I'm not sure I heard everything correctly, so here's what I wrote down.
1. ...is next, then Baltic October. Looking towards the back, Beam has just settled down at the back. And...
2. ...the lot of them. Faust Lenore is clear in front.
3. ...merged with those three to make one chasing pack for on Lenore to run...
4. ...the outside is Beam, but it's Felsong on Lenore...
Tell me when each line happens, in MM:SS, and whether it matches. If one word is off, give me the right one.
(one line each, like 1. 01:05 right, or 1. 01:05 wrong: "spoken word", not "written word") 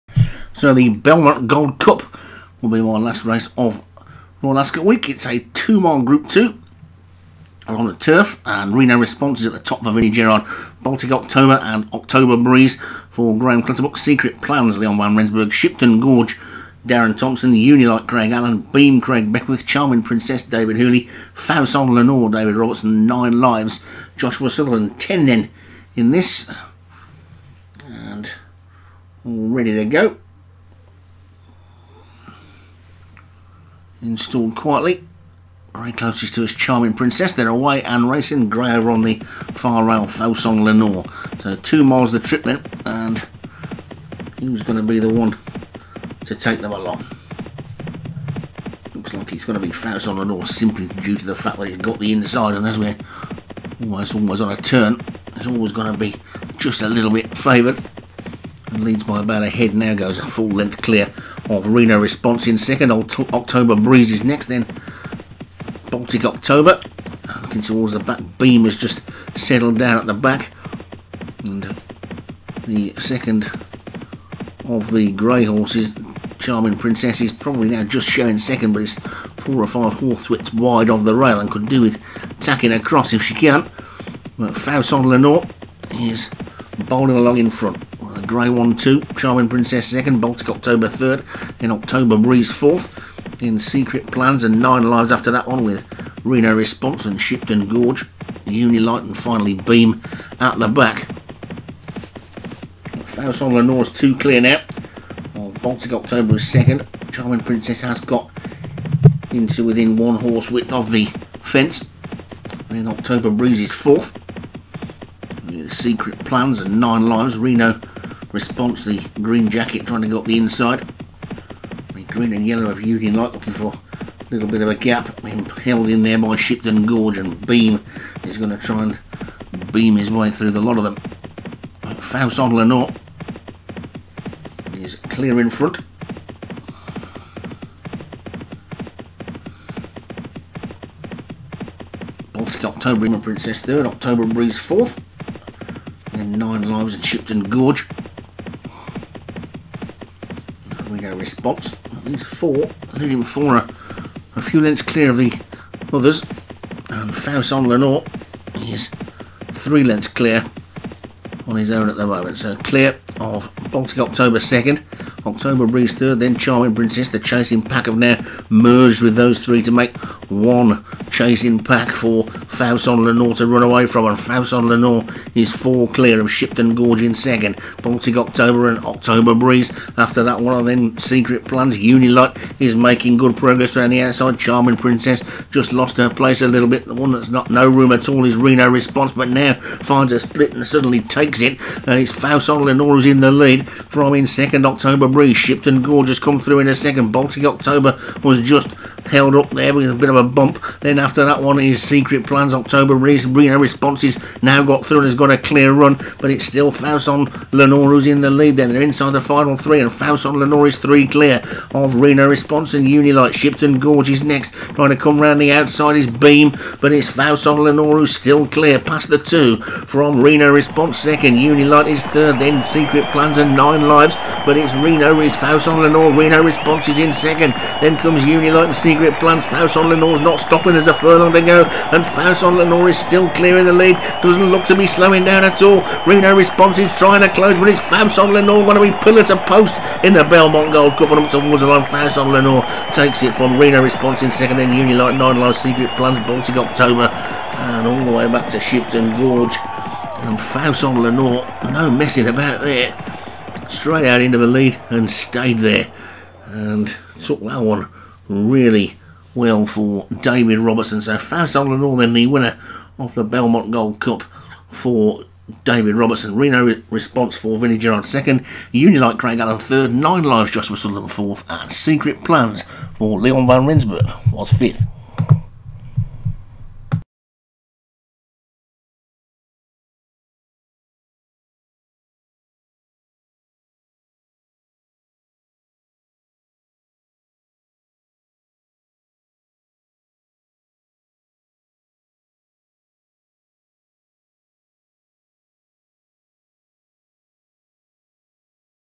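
1. 01:04 right
2. 02:10 right
3. 02:48 right
4. 03:35 wrong: "Faust", not "Felsong".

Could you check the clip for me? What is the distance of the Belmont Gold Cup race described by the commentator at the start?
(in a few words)
2 miles.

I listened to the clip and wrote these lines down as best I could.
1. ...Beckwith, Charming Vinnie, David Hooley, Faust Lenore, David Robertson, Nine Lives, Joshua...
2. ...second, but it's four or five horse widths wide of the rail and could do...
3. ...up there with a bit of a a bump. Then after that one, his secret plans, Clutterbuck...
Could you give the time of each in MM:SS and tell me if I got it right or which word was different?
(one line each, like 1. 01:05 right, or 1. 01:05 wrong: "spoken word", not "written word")
1. 00:19 wrong: "Princess", not "Vinnie"
2. 01:18 right
3. 03:19 wrong: "October", not "Clutterbuck".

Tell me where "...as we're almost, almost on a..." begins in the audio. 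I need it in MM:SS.
00:52.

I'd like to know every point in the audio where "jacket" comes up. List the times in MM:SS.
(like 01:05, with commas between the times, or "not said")
01:59.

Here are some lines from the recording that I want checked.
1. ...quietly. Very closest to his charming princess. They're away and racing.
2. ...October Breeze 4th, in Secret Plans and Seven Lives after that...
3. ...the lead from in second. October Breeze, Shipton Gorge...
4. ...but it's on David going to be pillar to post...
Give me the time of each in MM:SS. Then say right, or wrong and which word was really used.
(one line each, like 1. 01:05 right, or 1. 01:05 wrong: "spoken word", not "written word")
1. 00:34 right
2. 01:31 wrong: "Nine", not "Seven"
3. 03:13 right
4. 03:57 wrong: "Lenore", not "David".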